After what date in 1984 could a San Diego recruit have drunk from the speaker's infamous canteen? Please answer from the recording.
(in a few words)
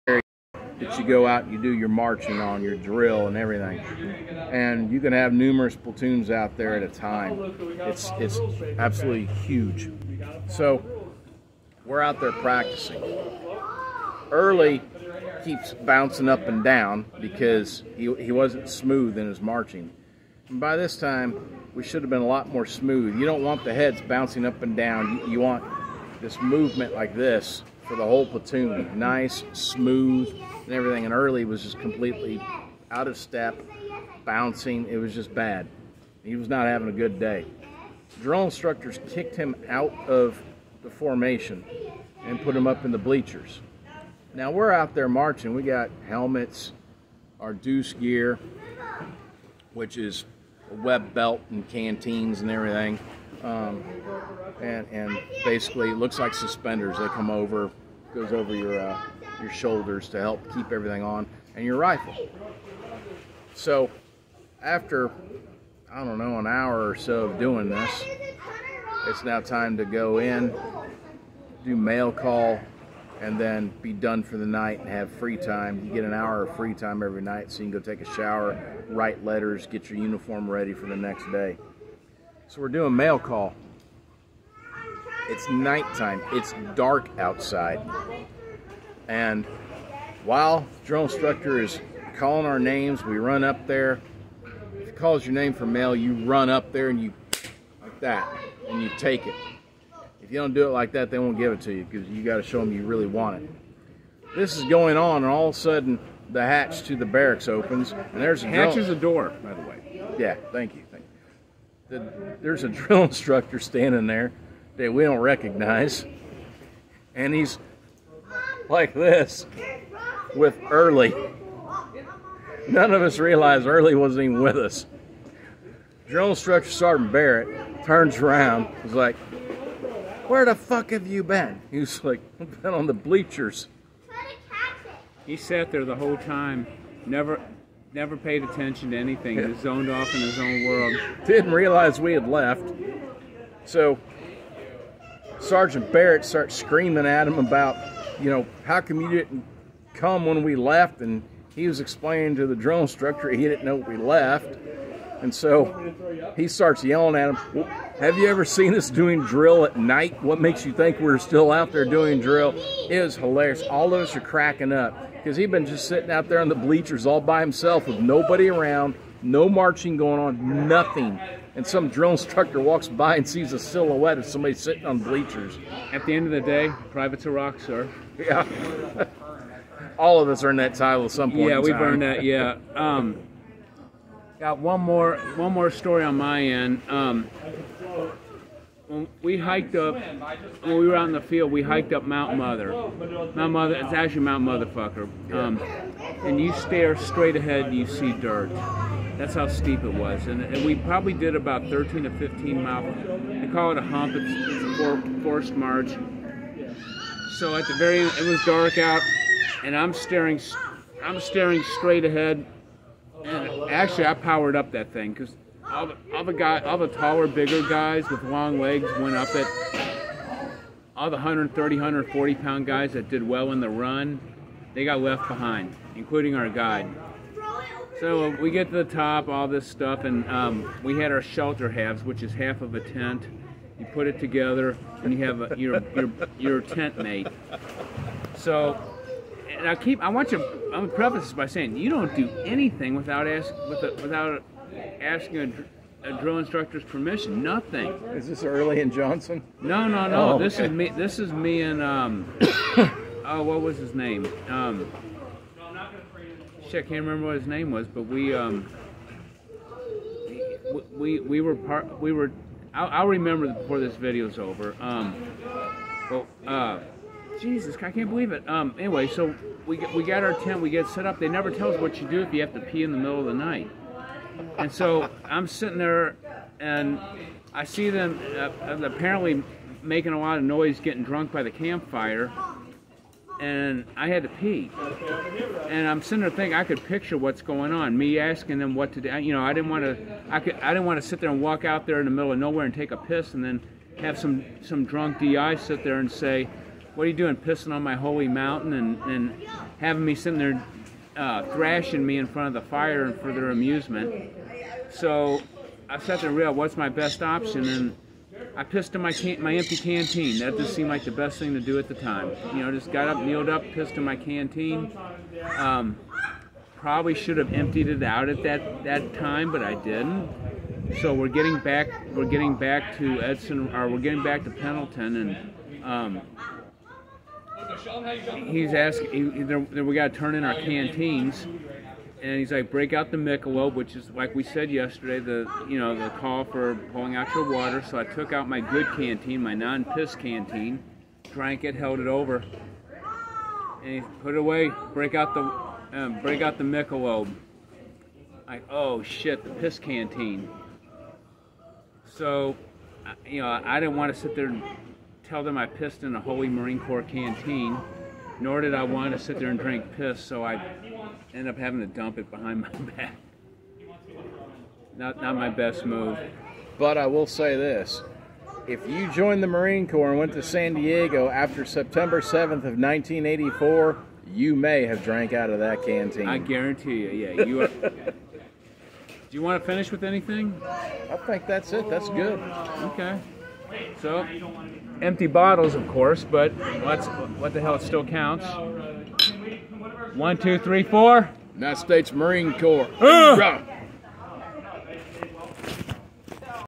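September 7th.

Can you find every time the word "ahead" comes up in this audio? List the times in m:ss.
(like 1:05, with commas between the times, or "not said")
3:17, 3:32.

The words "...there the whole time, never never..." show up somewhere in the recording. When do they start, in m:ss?
2:15.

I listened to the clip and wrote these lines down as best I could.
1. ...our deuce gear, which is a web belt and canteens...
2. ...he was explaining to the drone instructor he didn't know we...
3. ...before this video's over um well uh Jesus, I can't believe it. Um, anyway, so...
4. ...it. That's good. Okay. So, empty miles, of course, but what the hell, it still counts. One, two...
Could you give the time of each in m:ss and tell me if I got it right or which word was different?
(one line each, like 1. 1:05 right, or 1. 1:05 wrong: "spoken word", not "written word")
1. 0:47 right
2. 2:31 right
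3. 4:23 right
4. 6:21 wrong: "bottles", not "miles".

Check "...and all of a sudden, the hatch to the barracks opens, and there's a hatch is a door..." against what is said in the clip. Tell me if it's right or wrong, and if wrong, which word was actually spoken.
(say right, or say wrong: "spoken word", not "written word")
right.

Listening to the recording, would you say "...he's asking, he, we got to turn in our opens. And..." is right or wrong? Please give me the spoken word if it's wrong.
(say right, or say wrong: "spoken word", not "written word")
wrong: "canteens", not "opens".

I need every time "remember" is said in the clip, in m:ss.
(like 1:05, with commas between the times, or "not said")
4:17, 4:23.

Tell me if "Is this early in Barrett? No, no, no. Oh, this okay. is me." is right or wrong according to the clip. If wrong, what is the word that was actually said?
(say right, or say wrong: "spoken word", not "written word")
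wrong: "Johnson", not "Barrett".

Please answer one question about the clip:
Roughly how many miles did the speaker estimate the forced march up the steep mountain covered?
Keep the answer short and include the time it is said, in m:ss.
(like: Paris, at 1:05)
13 to 15 miles, at 3:21.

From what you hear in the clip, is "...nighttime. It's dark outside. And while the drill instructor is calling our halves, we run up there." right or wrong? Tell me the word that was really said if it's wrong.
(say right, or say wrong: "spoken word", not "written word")
wrong: "names", not "halves".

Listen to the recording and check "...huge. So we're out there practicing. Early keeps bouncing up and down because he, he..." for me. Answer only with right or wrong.
right.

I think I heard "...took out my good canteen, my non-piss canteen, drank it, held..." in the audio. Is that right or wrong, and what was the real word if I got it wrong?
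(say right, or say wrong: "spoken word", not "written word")
right.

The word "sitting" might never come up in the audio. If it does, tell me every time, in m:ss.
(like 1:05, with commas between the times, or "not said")
2:45, 2:54, 4:35, 4:46, 5:00.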